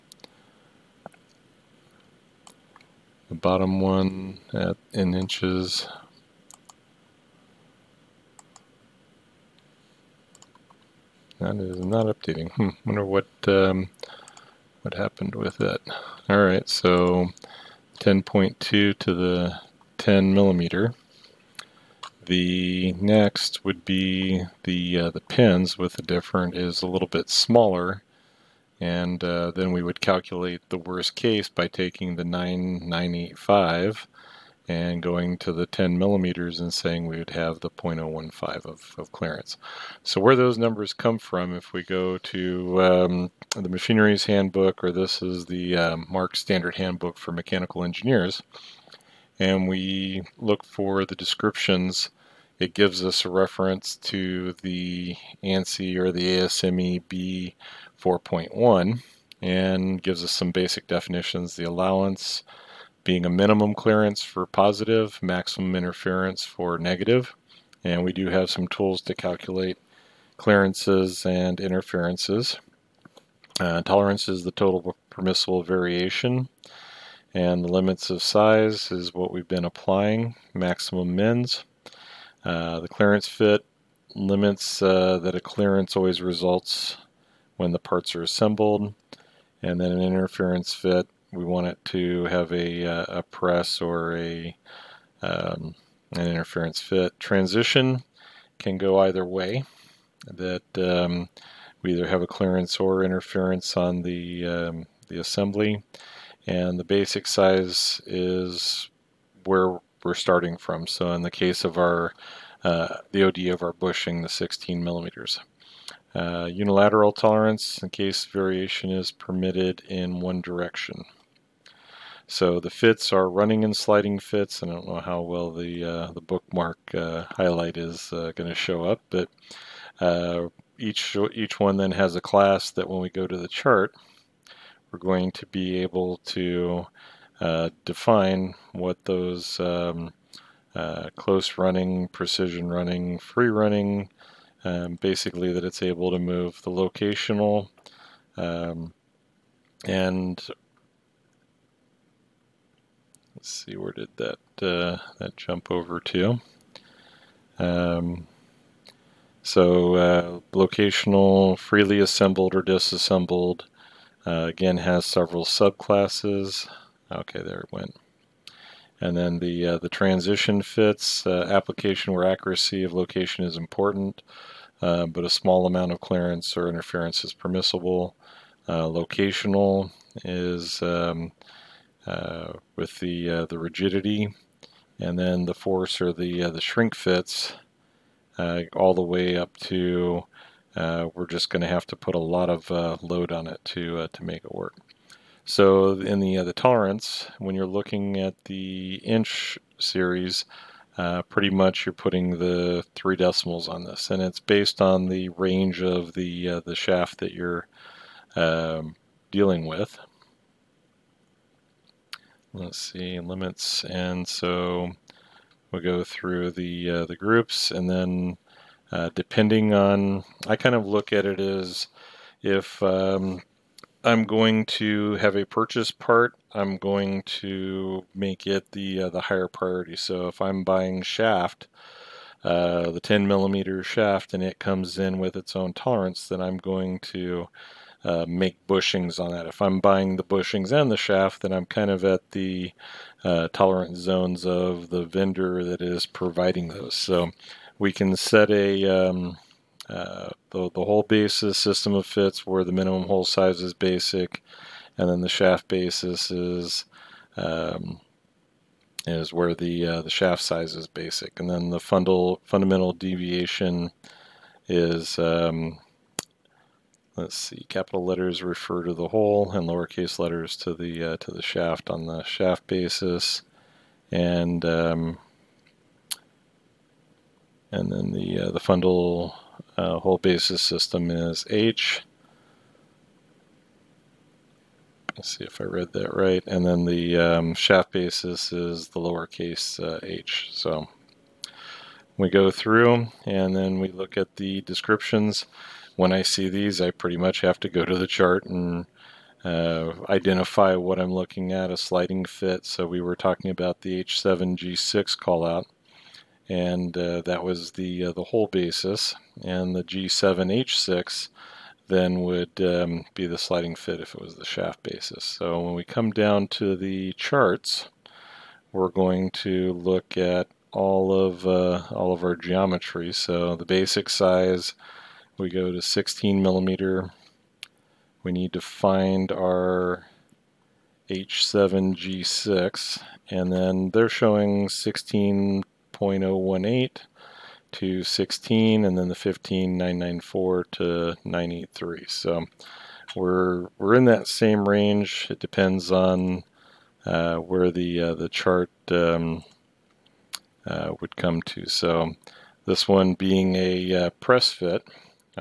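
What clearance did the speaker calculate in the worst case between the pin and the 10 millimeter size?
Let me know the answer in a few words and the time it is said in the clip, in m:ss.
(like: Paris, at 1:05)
0.015, at 0:37.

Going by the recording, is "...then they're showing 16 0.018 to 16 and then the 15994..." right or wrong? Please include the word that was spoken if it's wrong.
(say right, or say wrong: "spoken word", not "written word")
right.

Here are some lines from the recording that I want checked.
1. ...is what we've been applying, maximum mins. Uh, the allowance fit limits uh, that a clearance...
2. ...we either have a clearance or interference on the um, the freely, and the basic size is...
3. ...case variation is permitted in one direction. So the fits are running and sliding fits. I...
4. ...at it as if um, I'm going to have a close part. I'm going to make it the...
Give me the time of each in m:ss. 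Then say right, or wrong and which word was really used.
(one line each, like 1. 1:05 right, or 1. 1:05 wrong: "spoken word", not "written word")
1. 1:18 wrong: "clearance", not "allowance"
2. 1:41 wrong: "assembly", not "freely"
3. 1:57 right
4. 3:41 wrong: "purchase", not "close".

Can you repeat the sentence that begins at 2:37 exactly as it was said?
Um, so uh, locational, freely assembled or disassembled, uh, again has several subclasses.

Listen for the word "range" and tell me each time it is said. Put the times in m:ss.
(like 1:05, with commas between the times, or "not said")
3:25, 5:44.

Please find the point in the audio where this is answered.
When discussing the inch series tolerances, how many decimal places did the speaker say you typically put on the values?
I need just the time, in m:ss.
3:22.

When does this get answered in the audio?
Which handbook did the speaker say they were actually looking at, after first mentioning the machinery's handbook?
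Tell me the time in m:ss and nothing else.
0:46.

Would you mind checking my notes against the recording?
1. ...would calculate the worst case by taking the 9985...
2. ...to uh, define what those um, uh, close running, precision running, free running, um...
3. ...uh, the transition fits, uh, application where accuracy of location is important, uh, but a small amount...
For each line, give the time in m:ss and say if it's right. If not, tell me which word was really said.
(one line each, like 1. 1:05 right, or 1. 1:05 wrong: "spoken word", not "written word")
1. 0:29 right
2. 2:16 right
3. 2:49 right.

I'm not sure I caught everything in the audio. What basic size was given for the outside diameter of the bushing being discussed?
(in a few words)
16 millimeters.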